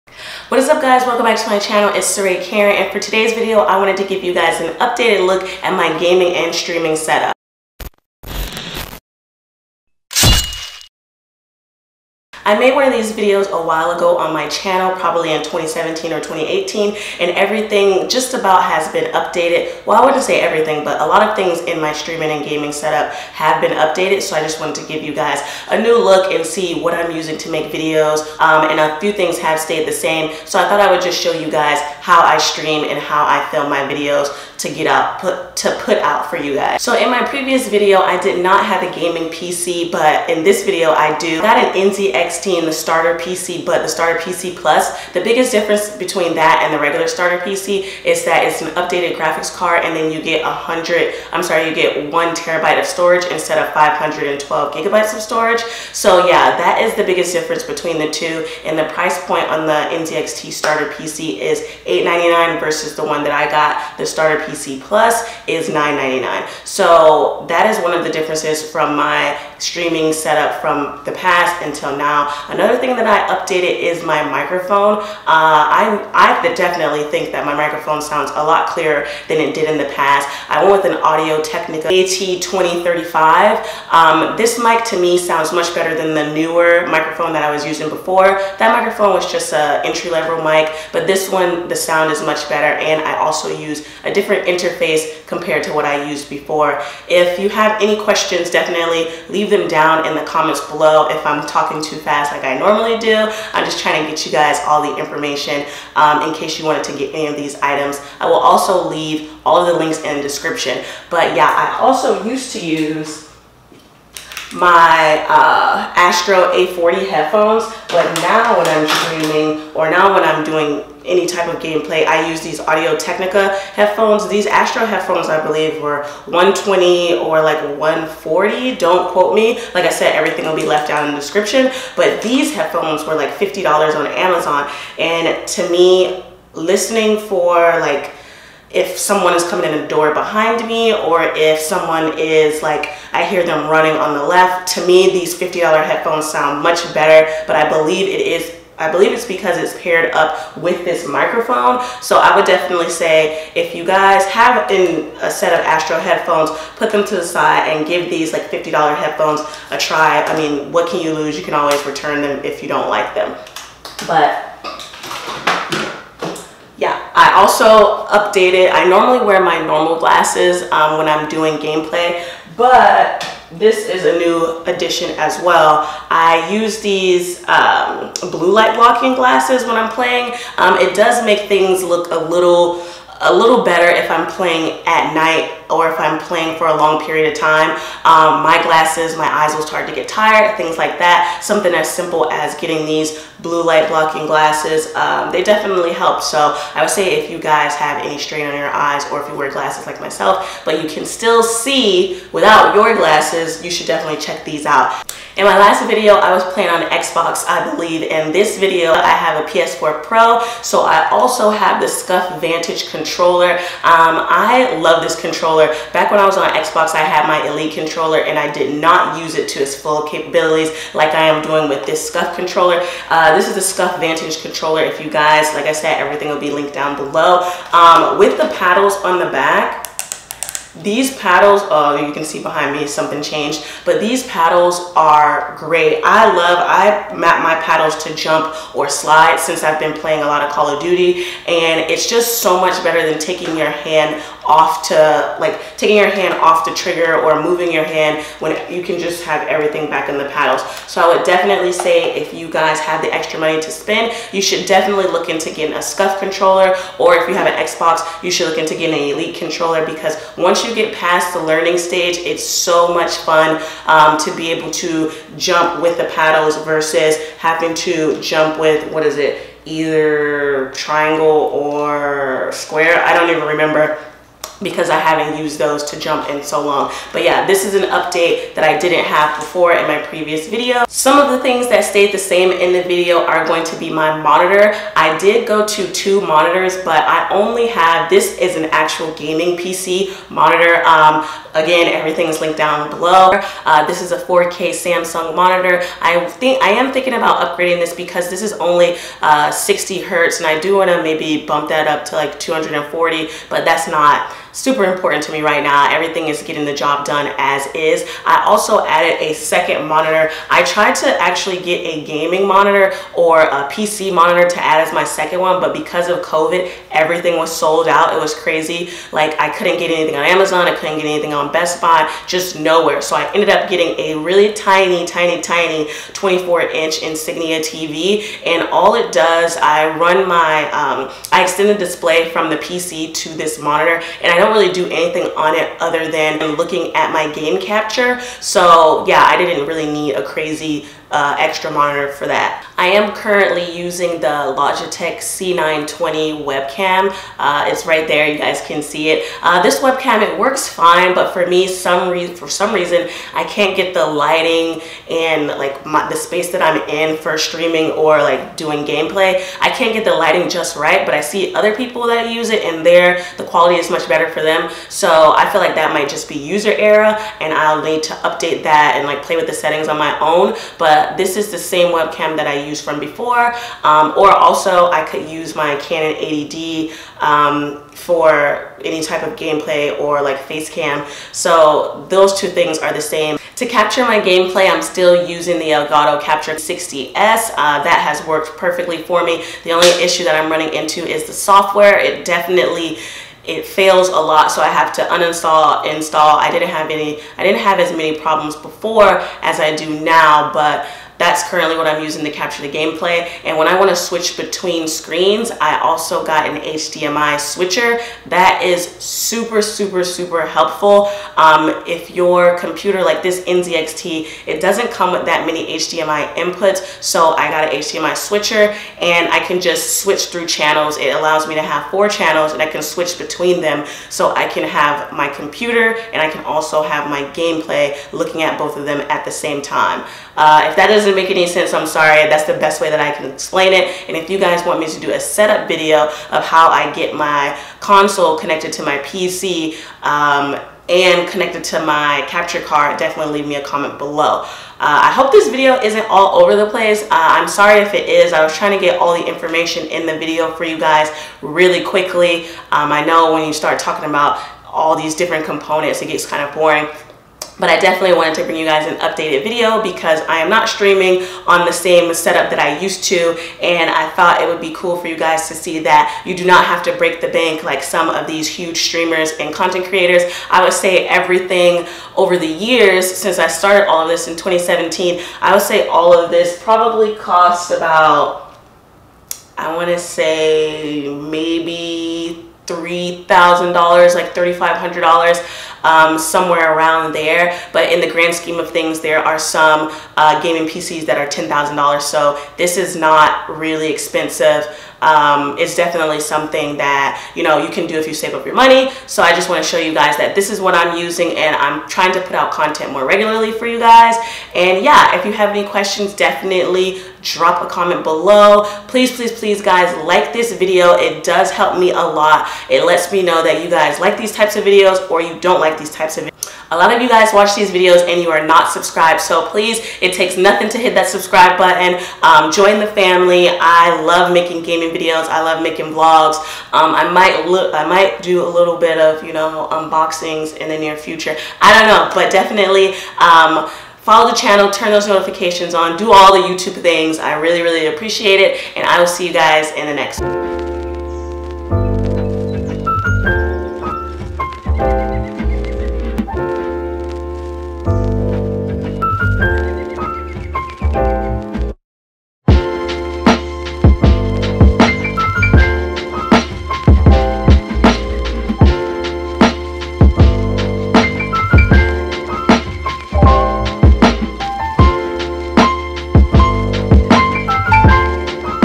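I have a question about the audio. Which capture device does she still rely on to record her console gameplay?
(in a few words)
Elgato Capture 60S.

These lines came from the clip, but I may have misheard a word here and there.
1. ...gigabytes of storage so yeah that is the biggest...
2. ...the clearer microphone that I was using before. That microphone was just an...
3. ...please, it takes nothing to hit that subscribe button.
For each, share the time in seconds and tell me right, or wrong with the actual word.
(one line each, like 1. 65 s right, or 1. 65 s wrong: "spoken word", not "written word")
1. 54 s right
2. 86 s wrong: "newer", not "clearer"
3. 519 s right.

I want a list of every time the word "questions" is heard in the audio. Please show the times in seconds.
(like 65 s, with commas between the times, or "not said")
98 s, 505 s.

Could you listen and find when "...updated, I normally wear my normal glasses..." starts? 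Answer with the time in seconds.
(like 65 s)
168 s.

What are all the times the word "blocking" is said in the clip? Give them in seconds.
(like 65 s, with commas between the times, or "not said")
178 s, 193 s.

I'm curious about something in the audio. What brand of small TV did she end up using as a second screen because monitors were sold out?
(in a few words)
Insignia.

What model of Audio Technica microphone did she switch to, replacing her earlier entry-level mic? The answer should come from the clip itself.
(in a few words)
AT2035.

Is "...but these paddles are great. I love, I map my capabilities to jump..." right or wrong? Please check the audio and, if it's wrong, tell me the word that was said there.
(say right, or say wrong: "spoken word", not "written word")
wrong: "paddles", not "capabilities".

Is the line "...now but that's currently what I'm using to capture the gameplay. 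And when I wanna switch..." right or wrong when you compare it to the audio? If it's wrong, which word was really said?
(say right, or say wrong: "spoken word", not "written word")
right.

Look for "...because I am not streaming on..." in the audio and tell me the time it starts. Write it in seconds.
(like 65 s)
459 s.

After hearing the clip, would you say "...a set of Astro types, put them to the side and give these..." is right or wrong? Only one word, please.
wrong.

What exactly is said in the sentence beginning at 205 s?
In my last video, I was playing on Xbox, I believe.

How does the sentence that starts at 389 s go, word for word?
The only issue that I'm running into is the software.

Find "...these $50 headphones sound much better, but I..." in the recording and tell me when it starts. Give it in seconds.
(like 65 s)
145 s.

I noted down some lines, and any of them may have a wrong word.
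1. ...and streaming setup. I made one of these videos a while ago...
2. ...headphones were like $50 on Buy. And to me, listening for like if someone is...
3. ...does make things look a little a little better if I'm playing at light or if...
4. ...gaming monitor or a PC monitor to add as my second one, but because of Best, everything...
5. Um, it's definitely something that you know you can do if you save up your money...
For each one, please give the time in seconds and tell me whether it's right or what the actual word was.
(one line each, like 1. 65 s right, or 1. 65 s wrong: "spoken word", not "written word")
1. 6 s right
2. 132 s wrong: "Amazon", not "Buy"
3. 180 s wrong: "night", not "light"
4. 312 s wrong: "COVID", not "Best"
5. 495 s right.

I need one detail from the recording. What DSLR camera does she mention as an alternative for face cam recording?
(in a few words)
Canon 80D.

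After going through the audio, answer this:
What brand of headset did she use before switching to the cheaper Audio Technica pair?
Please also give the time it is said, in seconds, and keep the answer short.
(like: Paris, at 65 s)
Astro A40, at 115 s.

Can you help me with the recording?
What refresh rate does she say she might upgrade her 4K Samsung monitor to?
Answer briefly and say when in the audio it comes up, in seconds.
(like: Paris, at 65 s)
240, at 302 s.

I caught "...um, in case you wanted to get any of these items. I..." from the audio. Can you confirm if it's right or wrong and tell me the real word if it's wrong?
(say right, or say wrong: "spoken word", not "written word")
right.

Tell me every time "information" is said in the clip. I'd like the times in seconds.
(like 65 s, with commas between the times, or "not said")
104 s, 449 s.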